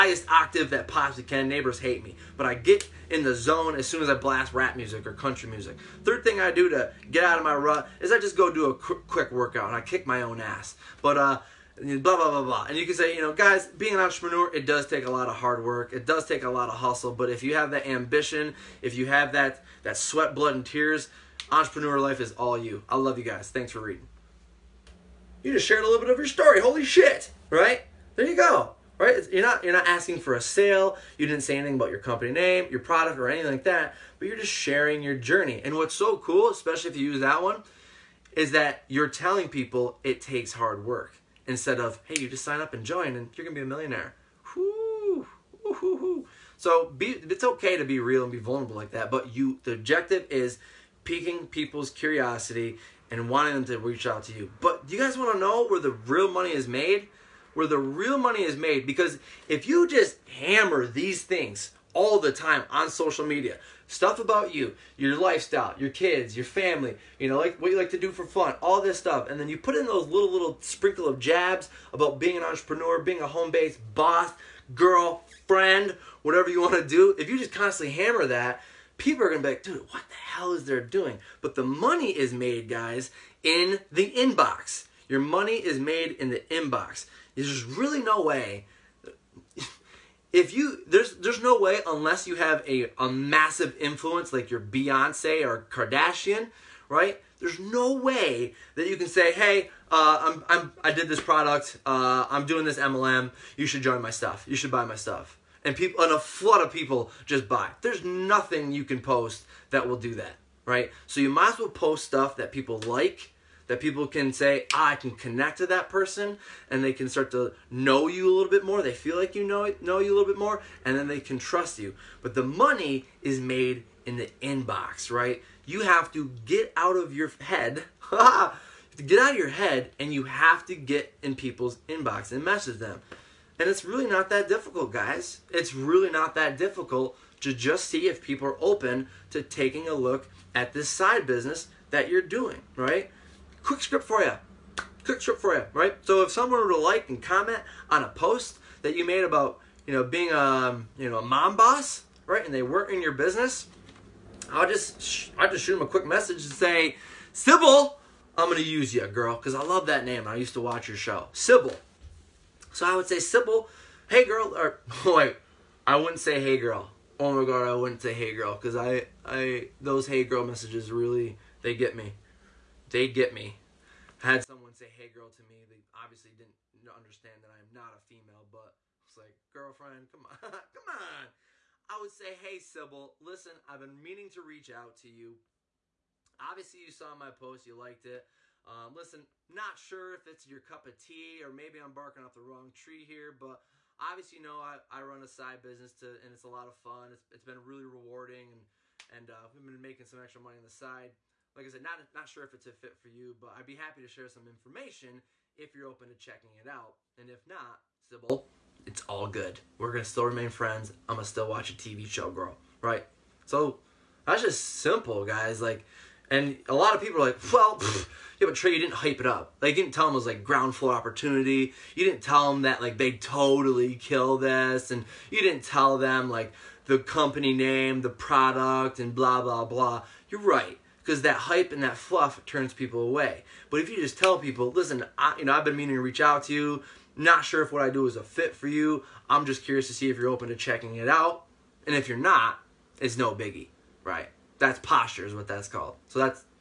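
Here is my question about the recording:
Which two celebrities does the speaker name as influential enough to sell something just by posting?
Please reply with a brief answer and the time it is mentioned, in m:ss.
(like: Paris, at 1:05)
Beyonce or Kardashian, at 1:34.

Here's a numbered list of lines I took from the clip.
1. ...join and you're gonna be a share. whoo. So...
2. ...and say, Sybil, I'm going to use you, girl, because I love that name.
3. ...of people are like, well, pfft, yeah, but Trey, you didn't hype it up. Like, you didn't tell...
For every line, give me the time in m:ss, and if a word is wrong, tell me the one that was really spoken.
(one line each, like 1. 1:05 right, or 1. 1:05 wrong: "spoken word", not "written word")
1. 0:42 wrong: "millionaire", not "share"
2. 2:36 right
3. 3:36 right.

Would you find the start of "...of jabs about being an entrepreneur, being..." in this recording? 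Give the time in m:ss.
1:11.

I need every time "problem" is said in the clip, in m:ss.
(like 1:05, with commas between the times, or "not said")
not said.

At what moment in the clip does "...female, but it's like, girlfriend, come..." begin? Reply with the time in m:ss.
2:57.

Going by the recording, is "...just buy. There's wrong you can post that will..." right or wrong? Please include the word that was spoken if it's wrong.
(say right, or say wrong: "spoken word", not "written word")
wrong: "nothing", not "wrong".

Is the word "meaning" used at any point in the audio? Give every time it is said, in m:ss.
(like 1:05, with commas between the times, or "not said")
3:04, 3:55.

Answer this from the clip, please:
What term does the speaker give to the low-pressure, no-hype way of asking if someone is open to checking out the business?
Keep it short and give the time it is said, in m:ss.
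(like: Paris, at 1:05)
Posture, at 4:04.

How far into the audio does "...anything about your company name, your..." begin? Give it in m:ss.
0:31.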